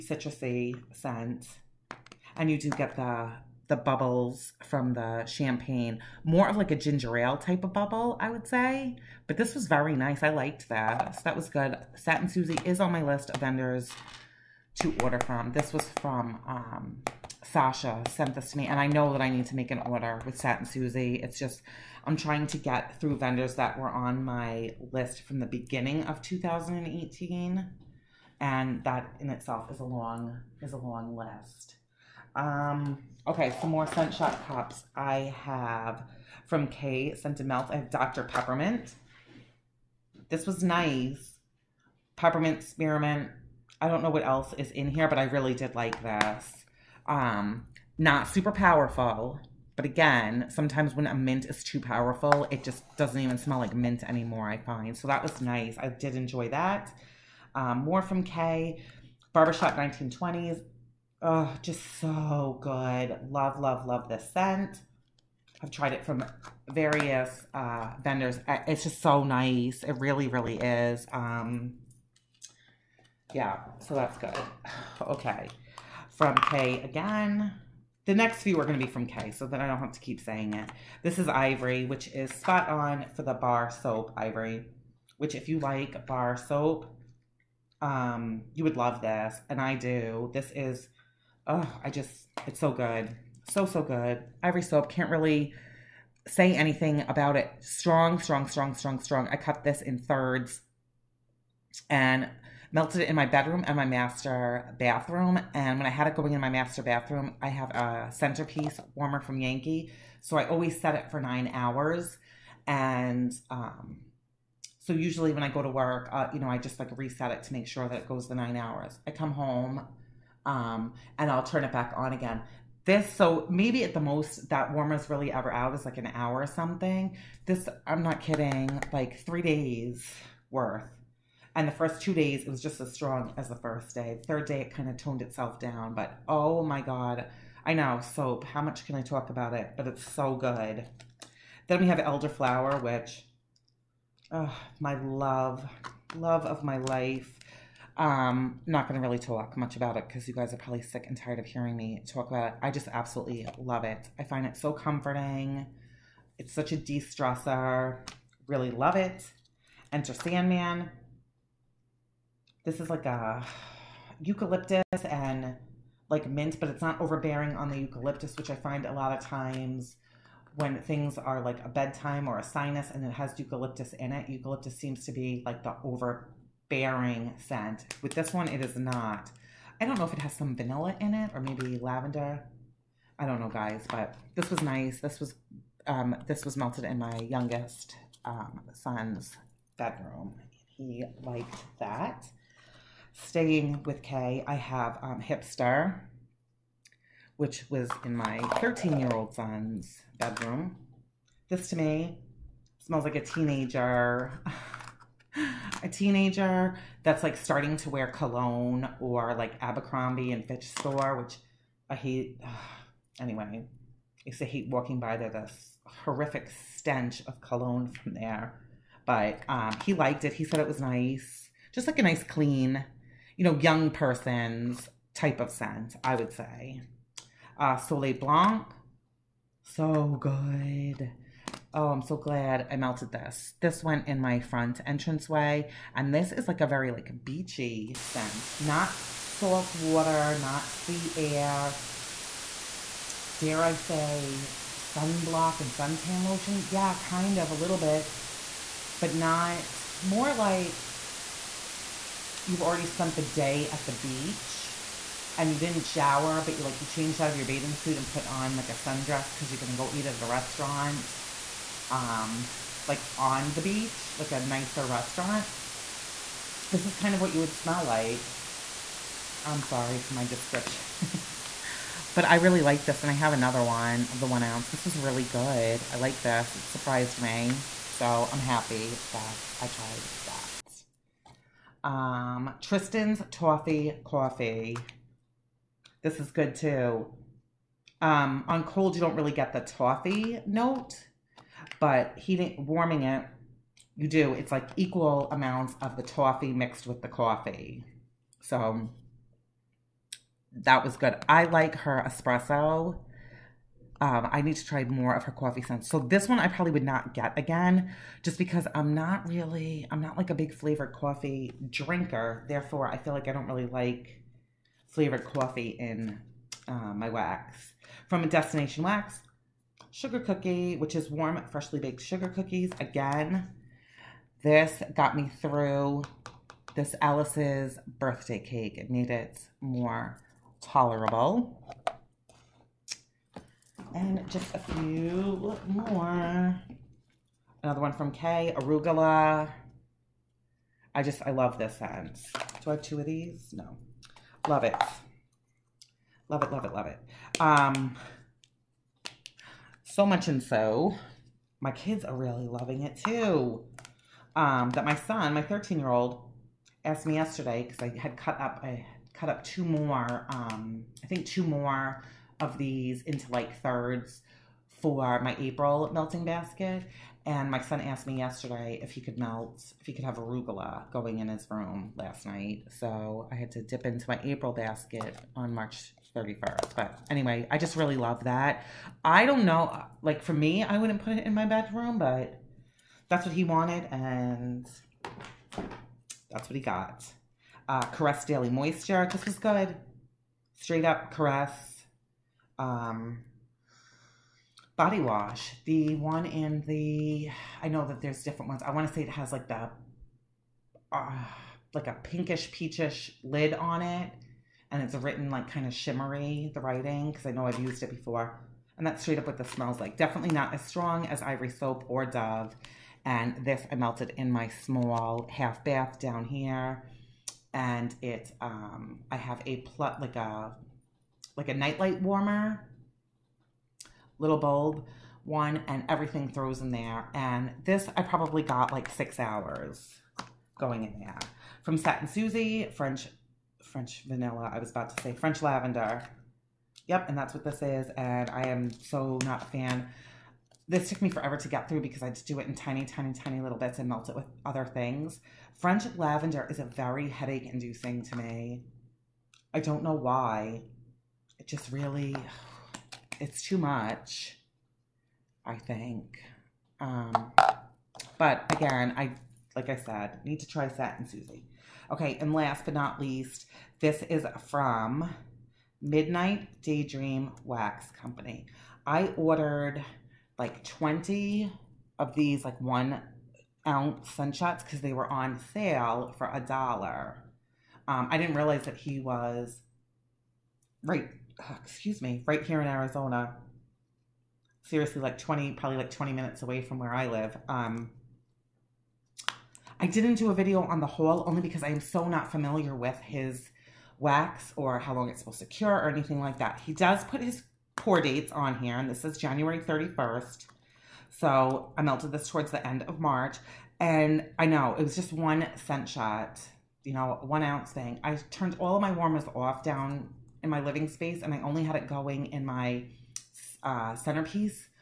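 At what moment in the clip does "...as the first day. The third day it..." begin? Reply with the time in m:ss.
2:13.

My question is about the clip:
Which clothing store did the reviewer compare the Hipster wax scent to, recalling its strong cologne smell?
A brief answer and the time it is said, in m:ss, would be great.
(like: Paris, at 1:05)
Abercrombie and Fitch, at 3:29.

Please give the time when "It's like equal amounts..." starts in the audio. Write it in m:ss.
4:54.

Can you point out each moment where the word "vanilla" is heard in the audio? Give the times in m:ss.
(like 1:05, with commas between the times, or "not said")
3:00, 7:14.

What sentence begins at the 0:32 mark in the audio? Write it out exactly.
Um, okay, some more Scent shot cups.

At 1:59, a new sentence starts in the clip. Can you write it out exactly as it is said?
I come home, um, and I'll turn it back on again.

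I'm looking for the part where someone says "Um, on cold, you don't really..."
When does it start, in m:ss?
4:48.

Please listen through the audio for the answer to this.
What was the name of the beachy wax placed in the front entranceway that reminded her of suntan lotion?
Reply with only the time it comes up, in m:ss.
3:47.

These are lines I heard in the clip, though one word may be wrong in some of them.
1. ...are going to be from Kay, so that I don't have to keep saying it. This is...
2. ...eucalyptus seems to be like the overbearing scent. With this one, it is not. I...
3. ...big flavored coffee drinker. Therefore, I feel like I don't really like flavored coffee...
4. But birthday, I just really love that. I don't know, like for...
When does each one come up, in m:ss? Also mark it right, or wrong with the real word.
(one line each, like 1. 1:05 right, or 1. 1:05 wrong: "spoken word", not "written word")
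1. 1:18 right
2. 2:54 right
3. 5:10 right
4. 6:16 wrong: "anyway", not "birthday".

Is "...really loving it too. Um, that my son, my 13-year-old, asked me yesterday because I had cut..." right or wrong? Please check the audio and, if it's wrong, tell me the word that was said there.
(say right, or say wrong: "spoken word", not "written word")
right.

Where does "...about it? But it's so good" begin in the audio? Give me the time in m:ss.
2:19.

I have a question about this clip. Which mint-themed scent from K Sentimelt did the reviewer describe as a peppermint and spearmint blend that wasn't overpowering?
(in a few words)
Dr. Peppermint.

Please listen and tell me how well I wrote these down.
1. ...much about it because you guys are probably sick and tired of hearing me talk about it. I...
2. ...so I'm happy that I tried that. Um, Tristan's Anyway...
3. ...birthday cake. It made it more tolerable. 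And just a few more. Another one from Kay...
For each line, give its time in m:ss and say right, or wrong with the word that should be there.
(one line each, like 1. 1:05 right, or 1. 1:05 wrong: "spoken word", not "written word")
1. 2:29 right
2. 4:37 wrong: "Toffee", not "Anyway"
3. 5:27 right.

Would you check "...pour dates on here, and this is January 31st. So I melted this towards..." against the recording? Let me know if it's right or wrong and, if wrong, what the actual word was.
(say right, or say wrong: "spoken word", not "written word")
right.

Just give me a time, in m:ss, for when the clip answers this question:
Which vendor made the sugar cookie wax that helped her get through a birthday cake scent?
5:18.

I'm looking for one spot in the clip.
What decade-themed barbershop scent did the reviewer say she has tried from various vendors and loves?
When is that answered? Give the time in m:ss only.
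0:59.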